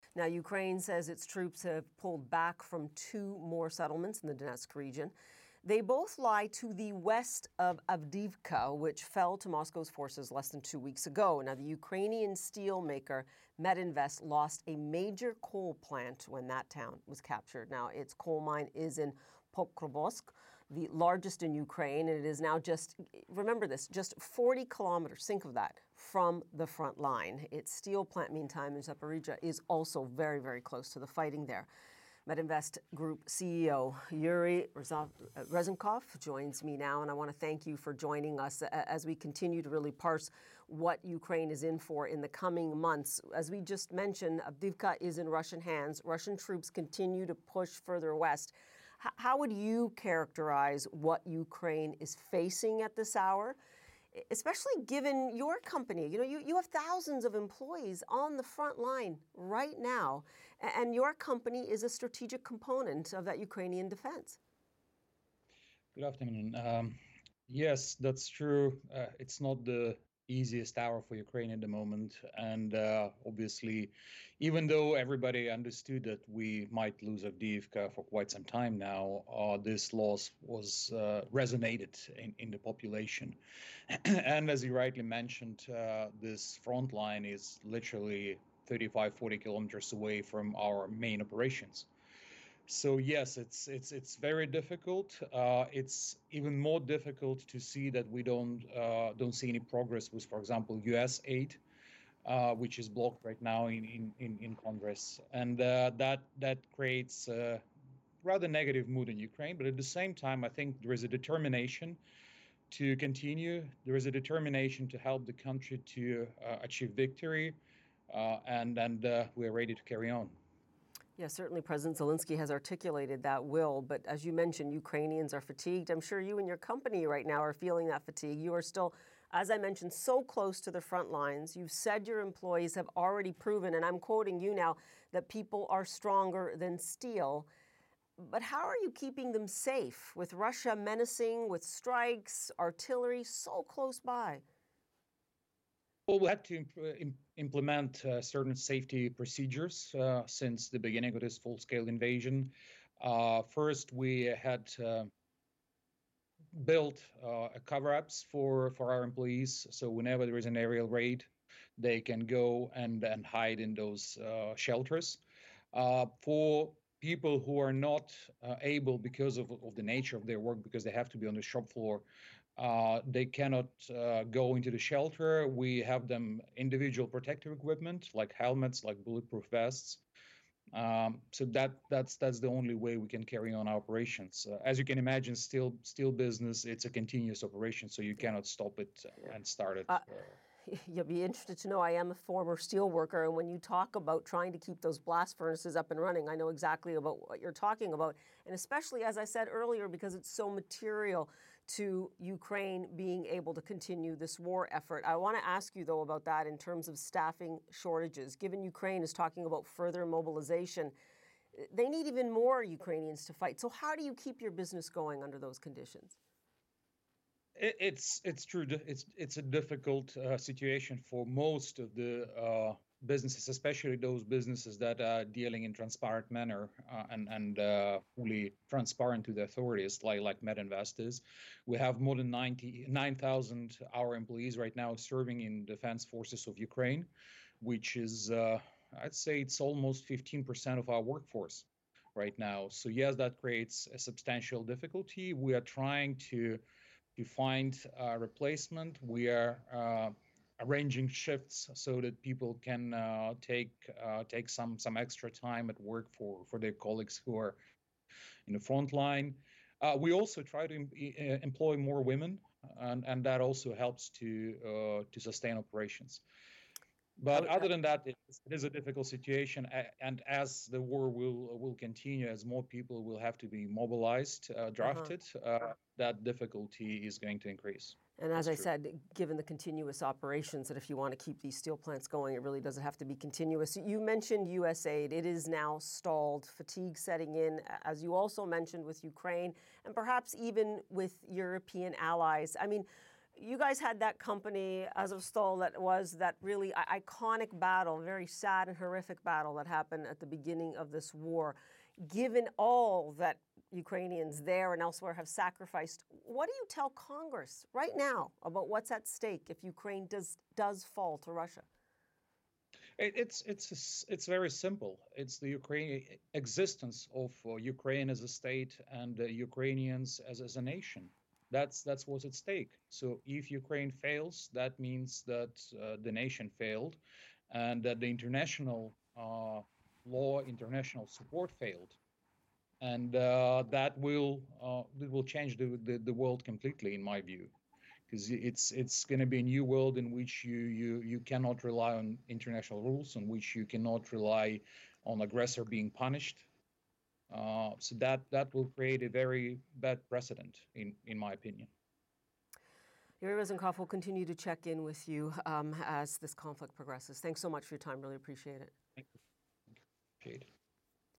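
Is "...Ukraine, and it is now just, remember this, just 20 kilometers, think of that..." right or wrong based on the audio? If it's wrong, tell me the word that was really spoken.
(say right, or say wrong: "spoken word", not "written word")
wrong: "40", not "20".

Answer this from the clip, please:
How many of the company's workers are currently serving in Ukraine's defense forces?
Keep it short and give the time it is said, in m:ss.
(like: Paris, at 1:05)
more than 9,000, at 3:51.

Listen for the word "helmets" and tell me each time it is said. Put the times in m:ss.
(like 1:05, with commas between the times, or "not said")
2:58.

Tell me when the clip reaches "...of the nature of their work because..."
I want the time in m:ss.
2:49.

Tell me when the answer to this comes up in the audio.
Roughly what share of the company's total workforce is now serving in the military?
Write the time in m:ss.
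3:59.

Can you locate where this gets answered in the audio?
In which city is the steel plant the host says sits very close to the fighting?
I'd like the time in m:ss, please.
0:28.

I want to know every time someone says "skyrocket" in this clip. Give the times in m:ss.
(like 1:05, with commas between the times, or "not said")
not said.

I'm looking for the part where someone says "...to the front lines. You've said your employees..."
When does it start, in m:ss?
2:10.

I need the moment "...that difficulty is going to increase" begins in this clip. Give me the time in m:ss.
4:35.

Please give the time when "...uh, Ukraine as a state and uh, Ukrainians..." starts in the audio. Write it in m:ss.
5:17.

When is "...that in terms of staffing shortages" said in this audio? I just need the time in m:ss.
3:26.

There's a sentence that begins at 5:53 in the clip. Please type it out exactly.
Yuriy Ryzhenkov will continue to check in with you um, as this conflict progresses.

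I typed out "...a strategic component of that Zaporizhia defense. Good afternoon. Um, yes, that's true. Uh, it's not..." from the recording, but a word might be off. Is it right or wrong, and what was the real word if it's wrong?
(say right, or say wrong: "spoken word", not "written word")
wrong: "Ukrainian", not "Zaporizhia".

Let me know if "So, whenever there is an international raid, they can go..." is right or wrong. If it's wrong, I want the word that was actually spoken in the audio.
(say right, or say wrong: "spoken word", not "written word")
wrong: "aerial", not "international".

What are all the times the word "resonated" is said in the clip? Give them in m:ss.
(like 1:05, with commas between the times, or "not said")
1:21.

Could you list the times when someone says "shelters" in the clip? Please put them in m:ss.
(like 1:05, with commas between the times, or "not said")
2:44, 2:54.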